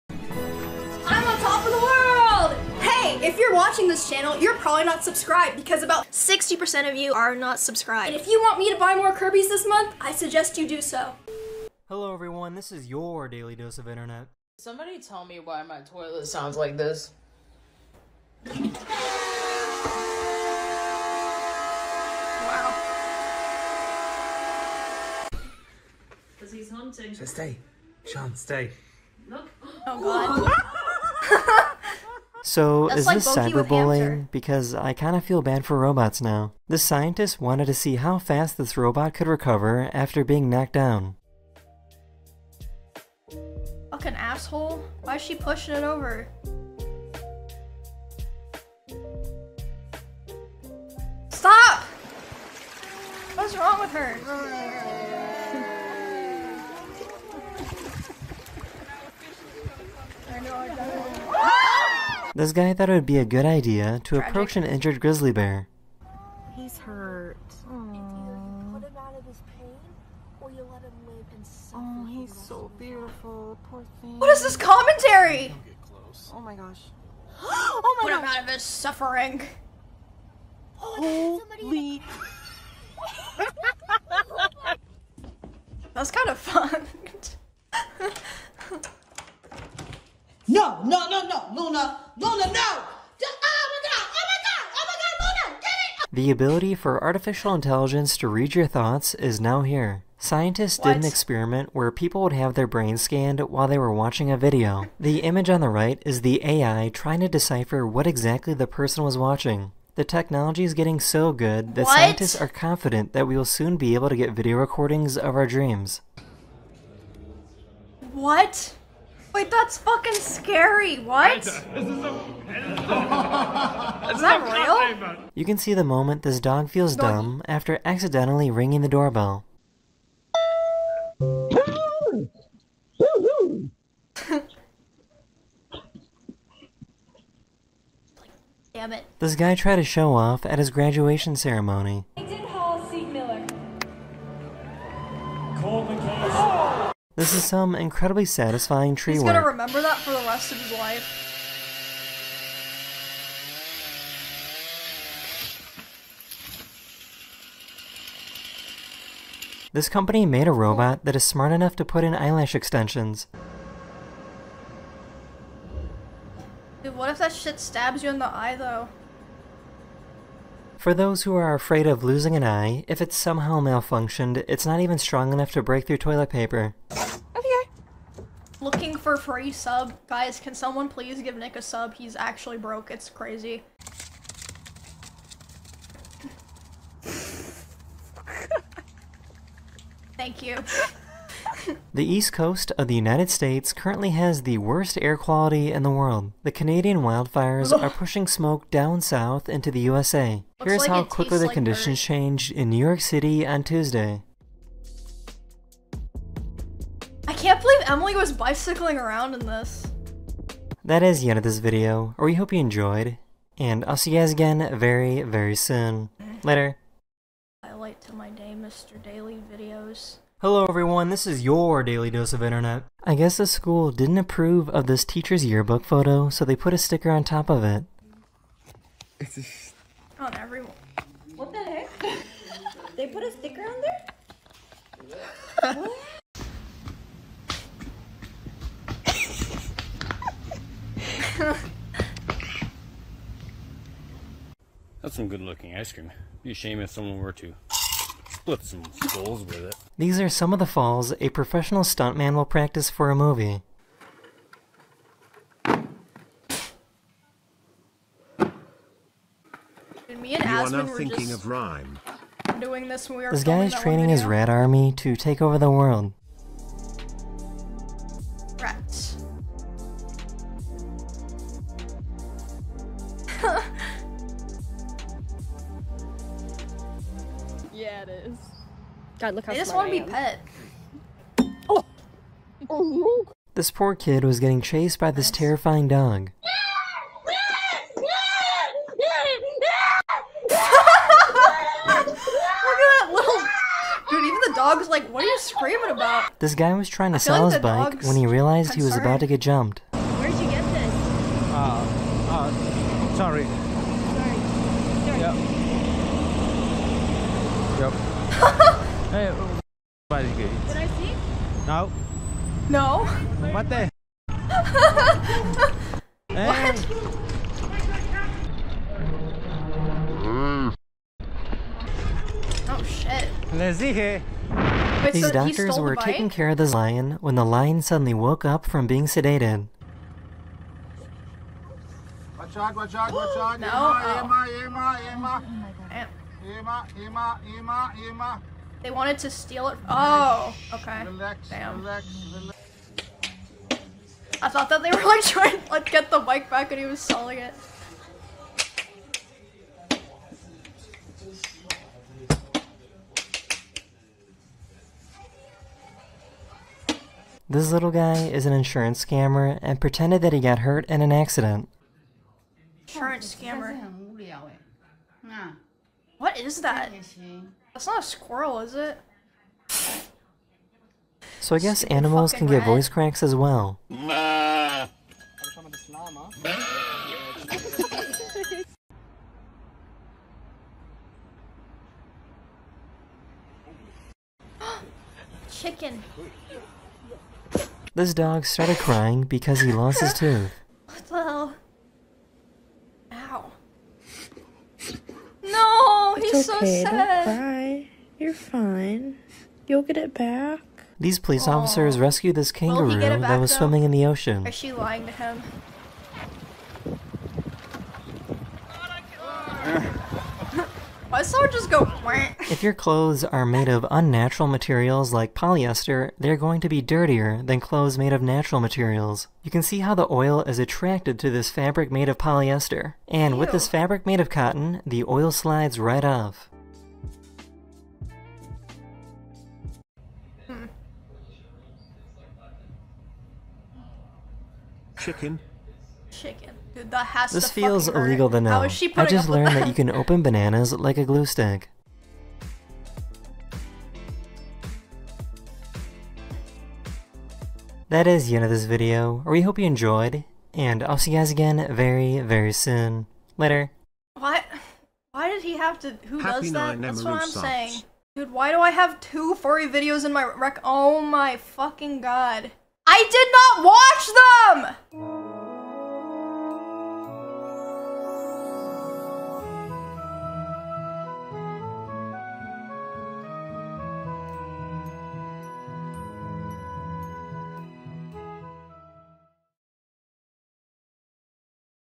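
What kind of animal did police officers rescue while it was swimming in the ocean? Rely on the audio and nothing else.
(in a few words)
kangaroo.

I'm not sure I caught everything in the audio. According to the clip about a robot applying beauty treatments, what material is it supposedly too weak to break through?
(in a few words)
toilet paper.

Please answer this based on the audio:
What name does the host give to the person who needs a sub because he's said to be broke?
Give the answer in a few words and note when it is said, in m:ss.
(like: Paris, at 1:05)
Nick, at 3:01.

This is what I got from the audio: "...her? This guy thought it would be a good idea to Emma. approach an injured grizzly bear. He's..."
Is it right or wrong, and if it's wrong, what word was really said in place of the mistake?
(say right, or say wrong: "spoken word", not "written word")
wrong: "Tragic", not "Emma".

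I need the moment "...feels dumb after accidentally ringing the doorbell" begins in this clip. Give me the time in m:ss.
2:06.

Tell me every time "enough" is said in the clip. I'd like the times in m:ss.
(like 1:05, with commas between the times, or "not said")
2:41, 2:55.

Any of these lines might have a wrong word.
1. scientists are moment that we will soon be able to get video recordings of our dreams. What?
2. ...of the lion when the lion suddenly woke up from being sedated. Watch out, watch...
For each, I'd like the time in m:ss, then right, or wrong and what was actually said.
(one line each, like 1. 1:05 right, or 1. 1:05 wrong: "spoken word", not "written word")
1. 1:51 wrong: "confident", not "moment"
2. 5:26 right.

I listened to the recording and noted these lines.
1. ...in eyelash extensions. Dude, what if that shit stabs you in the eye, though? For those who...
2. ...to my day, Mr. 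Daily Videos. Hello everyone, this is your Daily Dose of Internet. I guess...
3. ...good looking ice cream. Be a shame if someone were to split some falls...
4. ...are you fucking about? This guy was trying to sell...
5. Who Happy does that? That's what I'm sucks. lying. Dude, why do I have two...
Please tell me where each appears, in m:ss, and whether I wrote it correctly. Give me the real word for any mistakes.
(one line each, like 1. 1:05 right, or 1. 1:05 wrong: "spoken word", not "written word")
1. 2:42 right
2. 3:38 right
3. 4:05 wrong: "skulls", not "falls"
4. 4:55 wrong: "screaming", not "fucking"
5. 7:36 wrong: "saying", not "lying".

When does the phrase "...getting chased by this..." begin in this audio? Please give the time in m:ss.
4:44.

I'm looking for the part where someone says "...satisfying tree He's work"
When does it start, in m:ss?
2:28.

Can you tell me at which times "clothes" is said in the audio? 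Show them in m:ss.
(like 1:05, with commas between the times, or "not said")
6:52, 6:57.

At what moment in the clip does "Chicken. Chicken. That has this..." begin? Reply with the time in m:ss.
7:14.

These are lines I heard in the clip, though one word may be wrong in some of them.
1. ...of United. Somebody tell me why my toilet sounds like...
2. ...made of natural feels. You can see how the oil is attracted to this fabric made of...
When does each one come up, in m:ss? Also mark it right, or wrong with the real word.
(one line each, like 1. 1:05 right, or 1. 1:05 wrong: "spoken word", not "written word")
1. 0:13 wrong: "Internet", not "United"
2. 6:57 wrong: "materials", not "feels".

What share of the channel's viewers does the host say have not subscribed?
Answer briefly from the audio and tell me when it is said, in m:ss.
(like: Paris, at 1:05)
60%, at 0:06.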